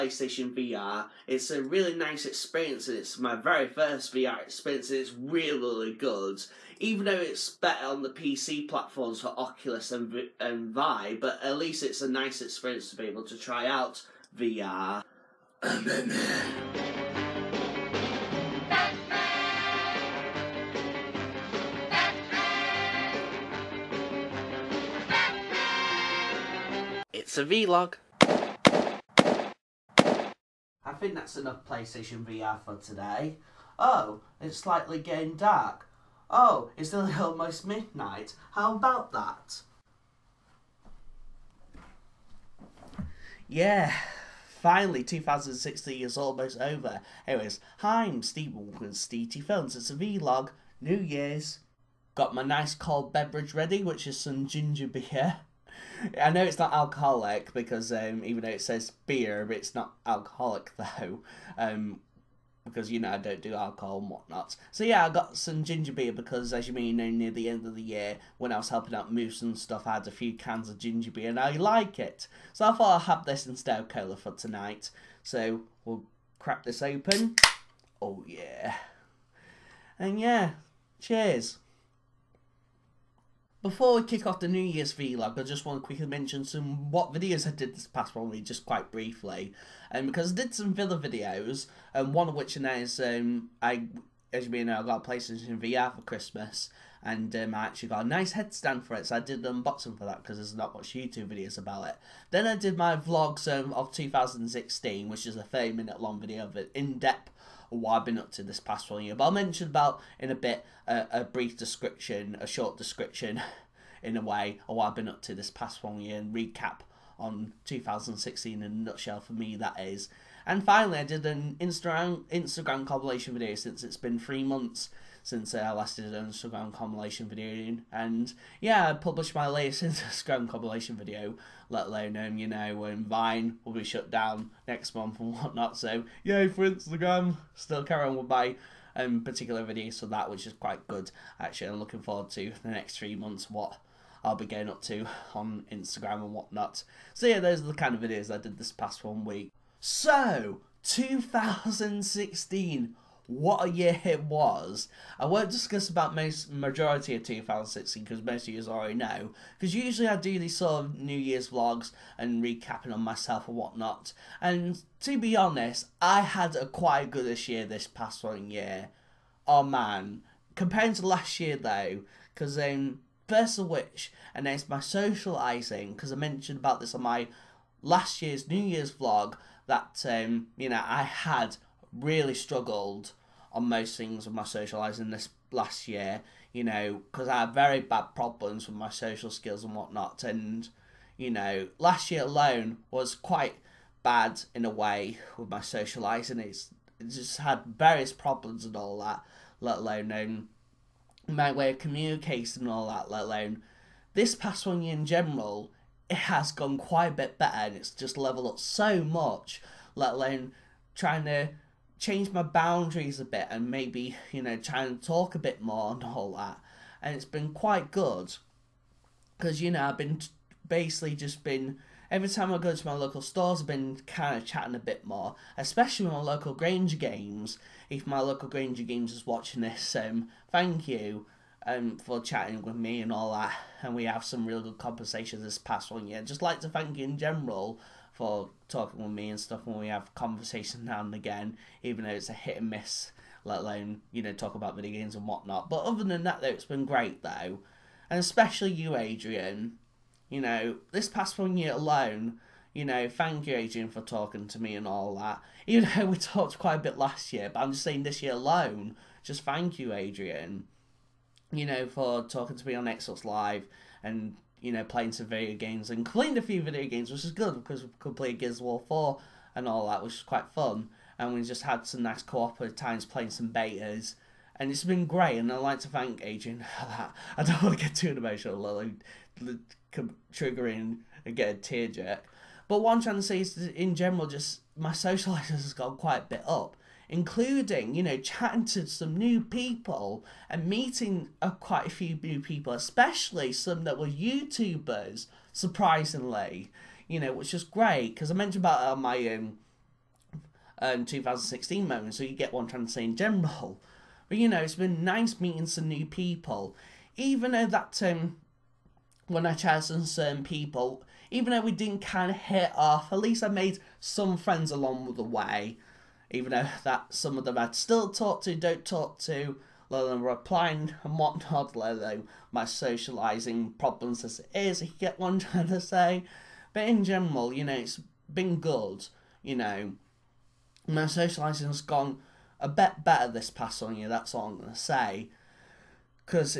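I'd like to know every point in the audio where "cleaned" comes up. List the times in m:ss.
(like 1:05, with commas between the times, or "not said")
4:26.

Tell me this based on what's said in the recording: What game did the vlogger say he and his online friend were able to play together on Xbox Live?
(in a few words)
Gears of War 4.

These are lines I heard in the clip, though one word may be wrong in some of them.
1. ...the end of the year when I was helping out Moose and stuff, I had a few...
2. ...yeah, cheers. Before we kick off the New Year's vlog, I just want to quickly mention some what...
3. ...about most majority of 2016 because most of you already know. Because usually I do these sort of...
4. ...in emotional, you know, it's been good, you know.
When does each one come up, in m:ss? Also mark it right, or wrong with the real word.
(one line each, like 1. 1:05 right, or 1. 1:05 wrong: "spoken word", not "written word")
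1. 1:07 right
2. 1:20 right
3. 2:35 right
4. 5:26 wrong: "general", not "emotional".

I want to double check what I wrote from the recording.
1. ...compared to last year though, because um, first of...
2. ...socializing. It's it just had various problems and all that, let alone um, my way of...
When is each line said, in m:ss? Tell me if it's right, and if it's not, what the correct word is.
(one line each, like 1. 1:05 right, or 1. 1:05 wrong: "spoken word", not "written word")
1. 2:50 right
2. 3:15 right.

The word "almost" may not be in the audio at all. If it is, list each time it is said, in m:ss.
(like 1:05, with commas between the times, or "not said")
0:37, 0:46.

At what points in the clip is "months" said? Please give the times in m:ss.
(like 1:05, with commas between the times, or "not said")
2:04, 2:14, 2:23.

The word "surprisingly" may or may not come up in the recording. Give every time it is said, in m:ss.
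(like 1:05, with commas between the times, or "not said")
4:55.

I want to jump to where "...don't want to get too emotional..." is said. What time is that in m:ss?
4:37.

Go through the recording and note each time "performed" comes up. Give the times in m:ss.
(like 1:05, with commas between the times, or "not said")
not said.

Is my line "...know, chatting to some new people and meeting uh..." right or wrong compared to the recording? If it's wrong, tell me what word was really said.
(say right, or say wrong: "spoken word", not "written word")
right.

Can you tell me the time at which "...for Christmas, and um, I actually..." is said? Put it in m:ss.
1:35.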